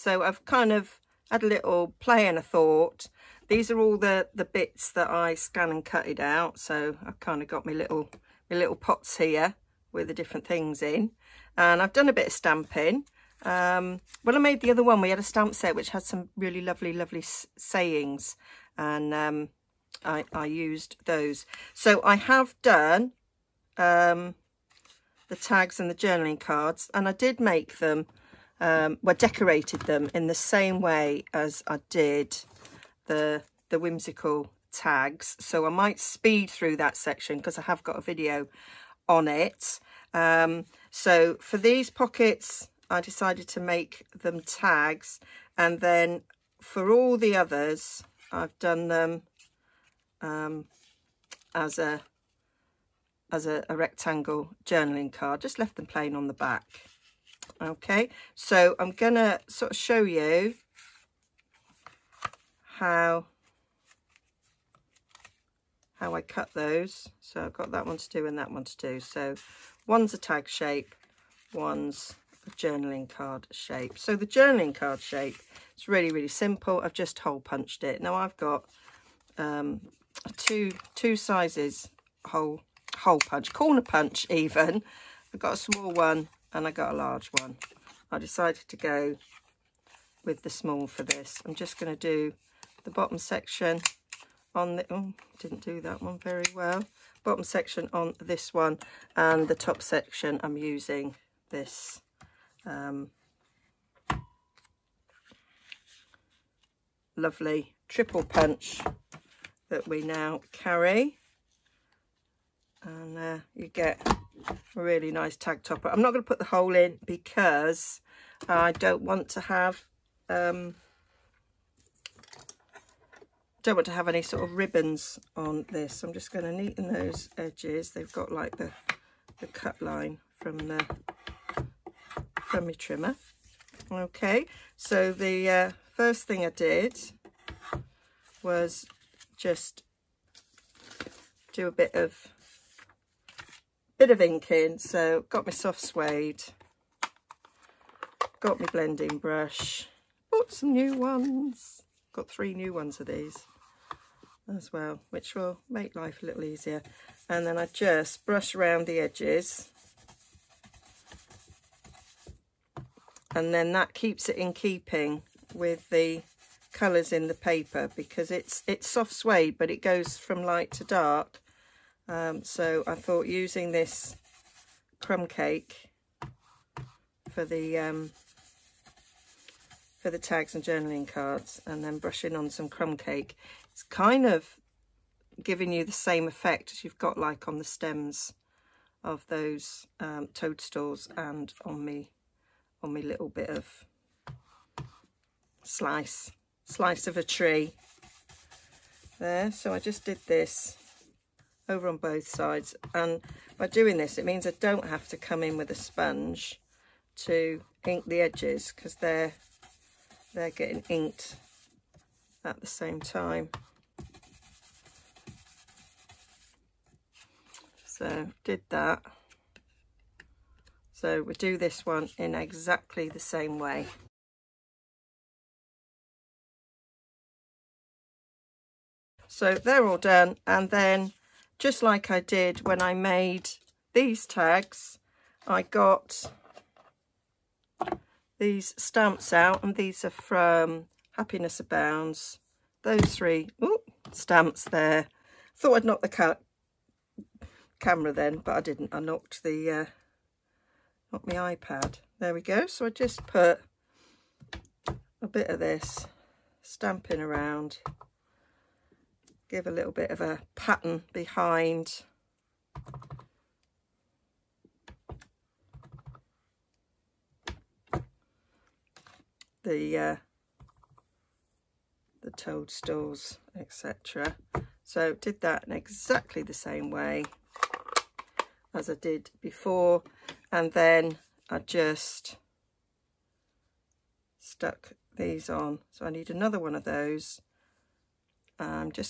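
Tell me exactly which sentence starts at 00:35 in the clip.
So I might speed through that section because I have got a video on it.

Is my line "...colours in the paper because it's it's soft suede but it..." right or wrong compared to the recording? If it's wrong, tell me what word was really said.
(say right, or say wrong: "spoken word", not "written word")
right.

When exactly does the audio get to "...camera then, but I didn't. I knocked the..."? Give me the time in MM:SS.
04:07.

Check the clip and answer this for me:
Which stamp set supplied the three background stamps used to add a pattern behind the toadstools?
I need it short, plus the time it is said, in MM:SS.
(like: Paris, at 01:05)
Happiness Abounds, at 04:01.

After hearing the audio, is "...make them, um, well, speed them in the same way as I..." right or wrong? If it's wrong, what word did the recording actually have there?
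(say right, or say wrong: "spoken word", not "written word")
wrong: "decorated", not "speed".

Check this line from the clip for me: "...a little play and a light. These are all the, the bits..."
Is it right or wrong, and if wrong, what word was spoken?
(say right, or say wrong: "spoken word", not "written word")
wrong: "thought", not "light".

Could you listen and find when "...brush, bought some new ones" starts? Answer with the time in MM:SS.
02:29.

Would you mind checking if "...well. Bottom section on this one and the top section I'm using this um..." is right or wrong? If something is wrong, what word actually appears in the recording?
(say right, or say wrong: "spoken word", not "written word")
right.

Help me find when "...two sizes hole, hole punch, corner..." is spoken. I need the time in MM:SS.
01:20.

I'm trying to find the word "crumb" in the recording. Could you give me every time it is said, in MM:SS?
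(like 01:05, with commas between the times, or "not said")
02:55, 03:02.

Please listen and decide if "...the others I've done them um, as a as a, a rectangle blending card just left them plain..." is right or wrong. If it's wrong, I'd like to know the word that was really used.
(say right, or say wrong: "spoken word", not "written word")
wrong: "journaling", not "blending".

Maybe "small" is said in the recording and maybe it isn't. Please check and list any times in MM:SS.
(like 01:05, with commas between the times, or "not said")
01:25, 01:30.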